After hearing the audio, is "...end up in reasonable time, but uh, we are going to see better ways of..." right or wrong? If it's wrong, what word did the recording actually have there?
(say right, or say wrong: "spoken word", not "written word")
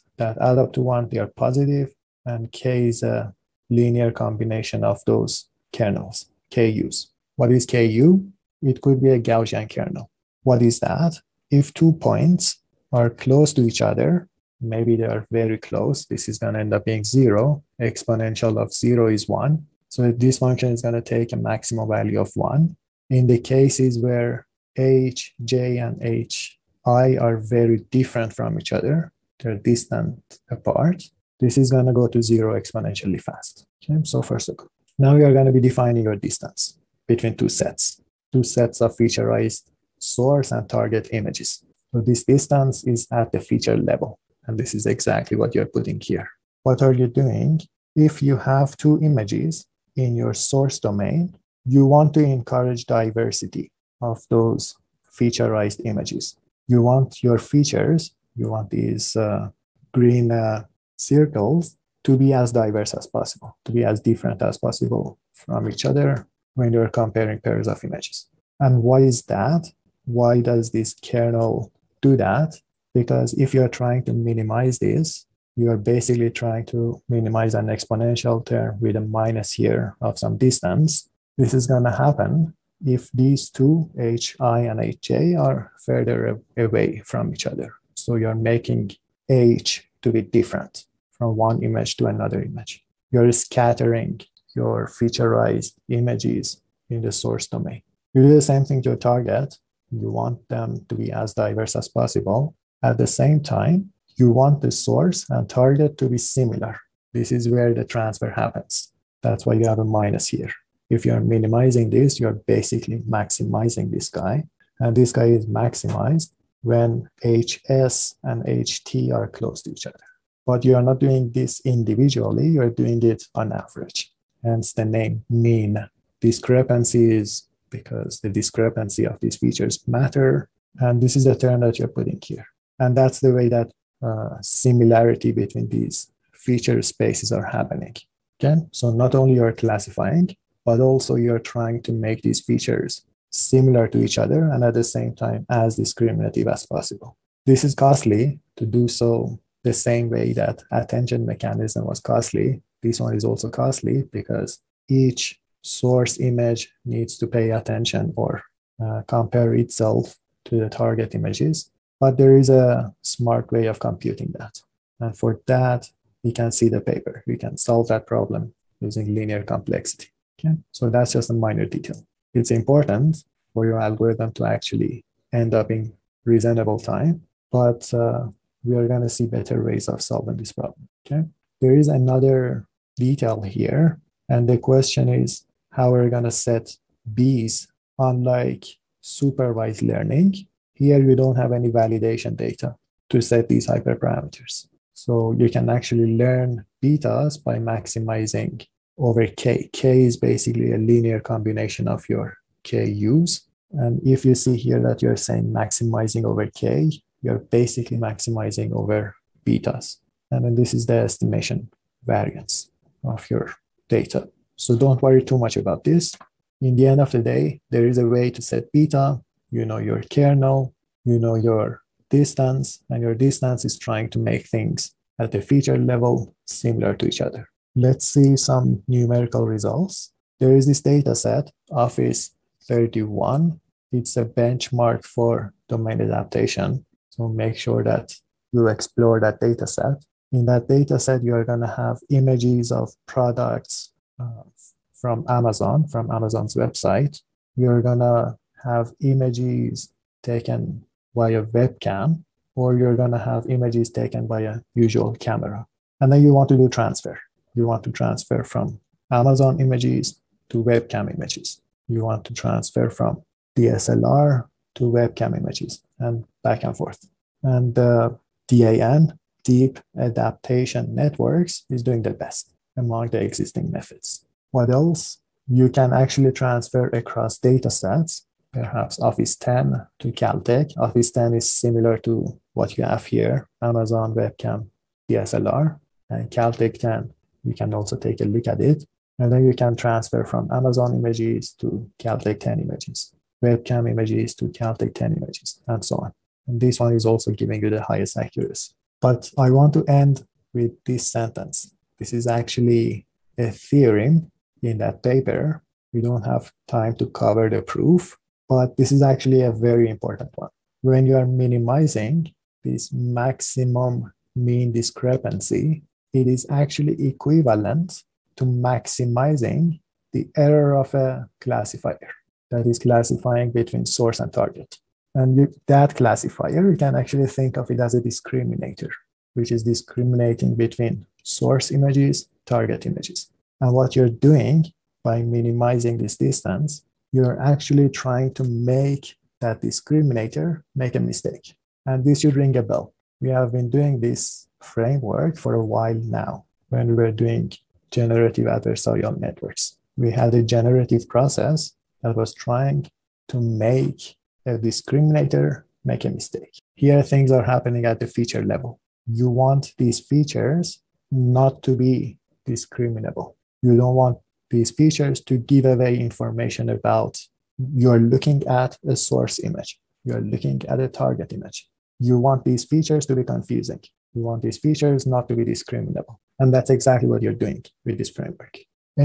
right.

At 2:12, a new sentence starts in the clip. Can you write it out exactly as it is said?
And that's the way that uh, similarity between these feature spaces are happening.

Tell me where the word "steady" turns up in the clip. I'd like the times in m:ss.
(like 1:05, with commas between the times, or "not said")
not said.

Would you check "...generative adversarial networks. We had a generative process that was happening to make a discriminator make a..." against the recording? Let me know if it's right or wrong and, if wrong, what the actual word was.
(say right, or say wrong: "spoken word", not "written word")
wrong: "trying", not "happening".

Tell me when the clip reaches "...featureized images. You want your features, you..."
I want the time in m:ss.
0:55.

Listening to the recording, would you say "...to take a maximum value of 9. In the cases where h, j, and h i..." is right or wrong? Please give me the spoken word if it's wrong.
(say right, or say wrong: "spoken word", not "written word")
wrong: "1", not "9".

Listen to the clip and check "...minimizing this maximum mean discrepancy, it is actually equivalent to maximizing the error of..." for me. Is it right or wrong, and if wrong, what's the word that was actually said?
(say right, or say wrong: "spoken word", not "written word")
right.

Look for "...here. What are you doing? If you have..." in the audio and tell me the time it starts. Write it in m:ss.
0:45.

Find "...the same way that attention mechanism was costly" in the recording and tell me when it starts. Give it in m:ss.
2:29.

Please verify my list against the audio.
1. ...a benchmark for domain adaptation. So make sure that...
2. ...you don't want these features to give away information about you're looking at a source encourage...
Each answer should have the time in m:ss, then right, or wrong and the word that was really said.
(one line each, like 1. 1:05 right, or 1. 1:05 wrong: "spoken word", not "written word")
1. 3:54 right
2. 6:03 wrong: "image", not "encourage".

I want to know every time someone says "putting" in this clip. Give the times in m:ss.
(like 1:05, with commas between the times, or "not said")
0:45, 2:11.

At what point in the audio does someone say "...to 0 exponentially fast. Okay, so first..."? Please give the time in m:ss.
0:32.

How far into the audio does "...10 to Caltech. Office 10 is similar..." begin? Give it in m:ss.
4:39.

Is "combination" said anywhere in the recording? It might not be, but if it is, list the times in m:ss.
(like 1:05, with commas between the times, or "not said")
0:04, 3:21.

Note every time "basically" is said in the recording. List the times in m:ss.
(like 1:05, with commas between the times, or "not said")
1:15, 1:52, 3:20, 3:27.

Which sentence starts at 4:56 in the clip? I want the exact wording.
And this one is also giving you the highest accuracy.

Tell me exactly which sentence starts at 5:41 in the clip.
And this should ring a bell.